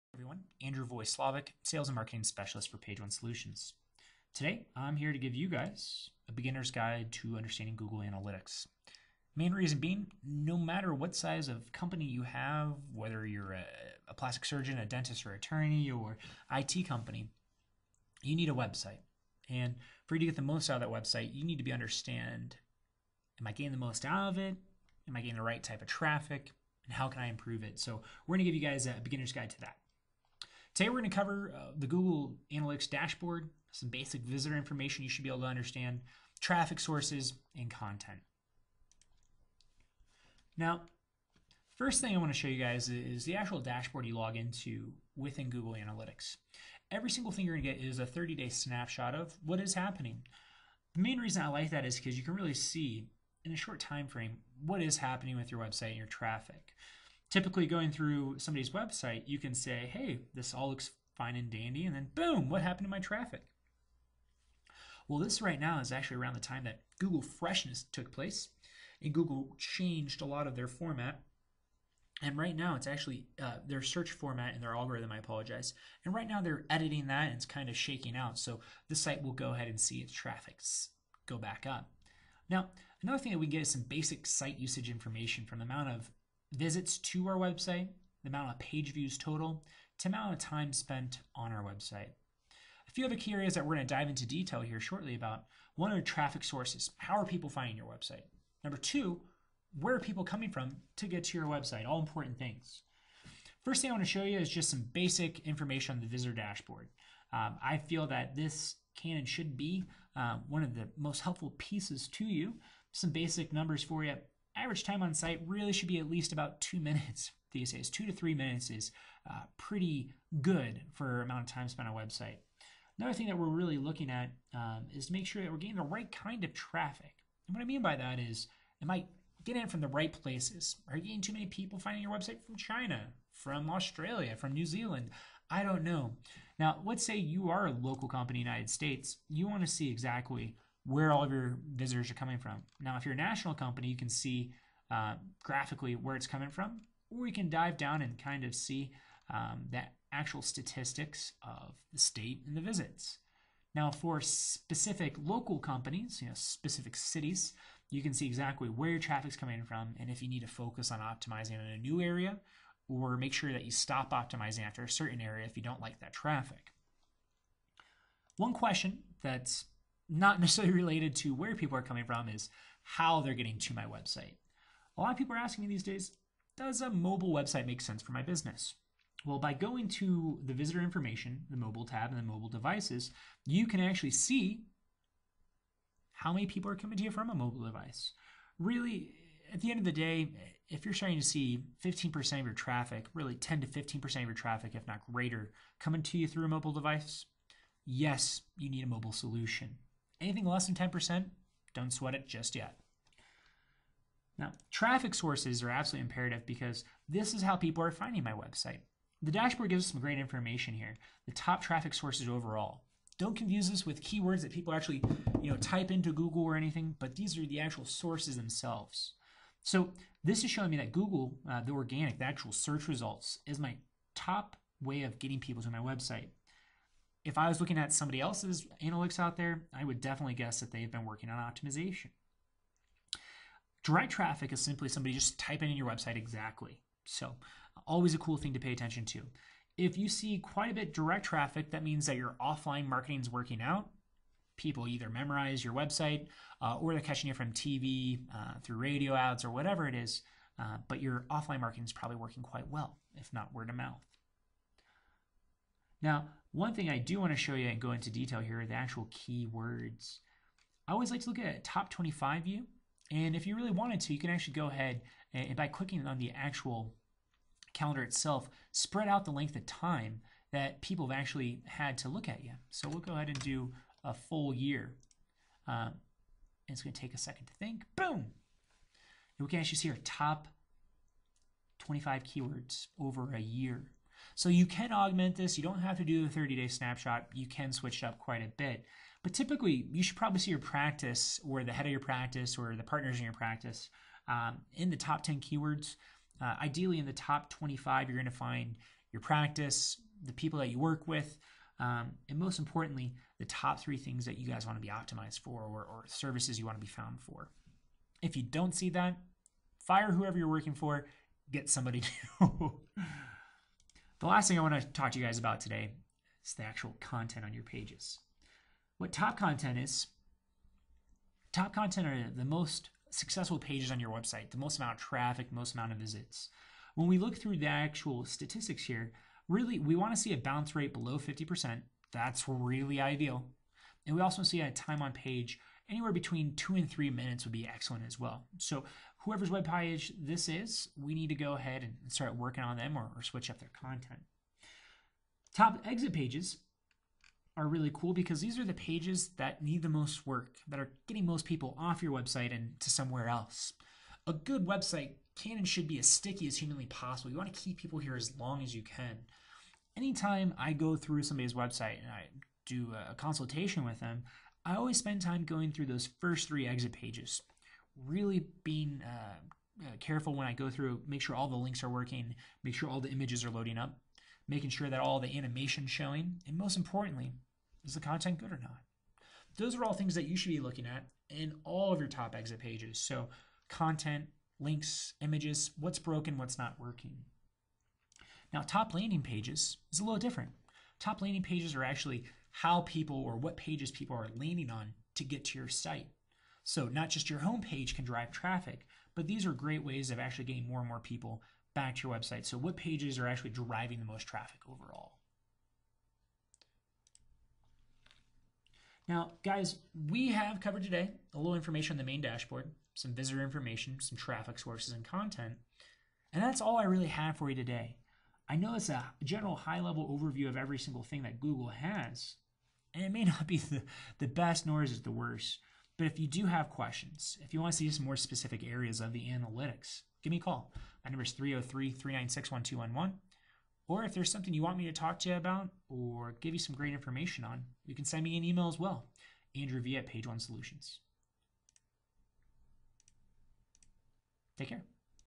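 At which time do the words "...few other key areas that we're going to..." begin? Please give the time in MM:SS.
01:32.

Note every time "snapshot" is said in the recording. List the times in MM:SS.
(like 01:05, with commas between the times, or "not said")
00:48, 04:46.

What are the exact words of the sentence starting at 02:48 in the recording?
One question that's not necessarily related to where people are coming from, is how they're getting to my website.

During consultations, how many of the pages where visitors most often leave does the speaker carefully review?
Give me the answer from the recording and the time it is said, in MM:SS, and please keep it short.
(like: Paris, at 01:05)
3, at 06:06.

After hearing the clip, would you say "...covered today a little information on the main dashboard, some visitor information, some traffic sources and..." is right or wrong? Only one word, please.
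right.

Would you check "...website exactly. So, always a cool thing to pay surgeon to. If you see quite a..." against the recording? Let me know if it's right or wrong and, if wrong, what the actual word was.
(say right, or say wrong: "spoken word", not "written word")
wrong: "attention", not "surgeon".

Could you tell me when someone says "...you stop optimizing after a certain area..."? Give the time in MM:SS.
02:43.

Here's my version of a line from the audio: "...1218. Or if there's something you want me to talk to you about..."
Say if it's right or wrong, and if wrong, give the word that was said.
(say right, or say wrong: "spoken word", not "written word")
wrong: "1211", not "1218".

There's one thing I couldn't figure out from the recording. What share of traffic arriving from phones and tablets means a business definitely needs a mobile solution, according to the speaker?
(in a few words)
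10 to 15%.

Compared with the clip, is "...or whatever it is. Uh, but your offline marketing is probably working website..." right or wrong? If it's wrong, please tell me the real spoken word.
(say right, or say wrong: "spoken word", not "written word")
wrong: "quite", not "website".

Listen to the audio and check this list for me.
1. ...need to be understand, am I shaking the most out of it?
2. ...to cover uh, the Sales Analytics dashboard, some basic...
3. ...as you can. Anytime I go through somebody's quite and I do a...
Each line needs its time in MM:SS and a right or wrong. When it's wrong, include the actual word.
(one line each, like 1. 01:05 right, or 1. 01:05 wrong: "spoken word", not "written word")
1. 00:21 wrong: "getting", not "shaking"
2. 00:31 wrong: "Google", not "Sales"
3. 05:58 wrong: "website", not "quite".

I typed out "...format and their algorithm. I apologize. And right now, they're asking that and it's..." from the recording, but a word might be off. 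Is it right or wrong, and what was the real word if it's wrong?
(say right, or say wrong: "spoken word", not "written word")
wrong: "editing", not "asking".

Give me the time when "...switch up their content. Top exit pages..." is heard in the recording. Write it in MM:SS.
05:43.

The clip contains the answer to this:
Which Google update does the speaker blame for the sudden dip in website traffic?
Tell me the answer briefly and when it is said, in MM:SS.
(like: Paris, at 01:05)
Google Freshness, at 01:06.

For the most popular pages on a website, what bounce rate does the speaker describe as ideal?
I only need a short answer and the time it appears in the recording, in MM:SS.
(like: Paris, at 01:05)
below 50%, at 05:30.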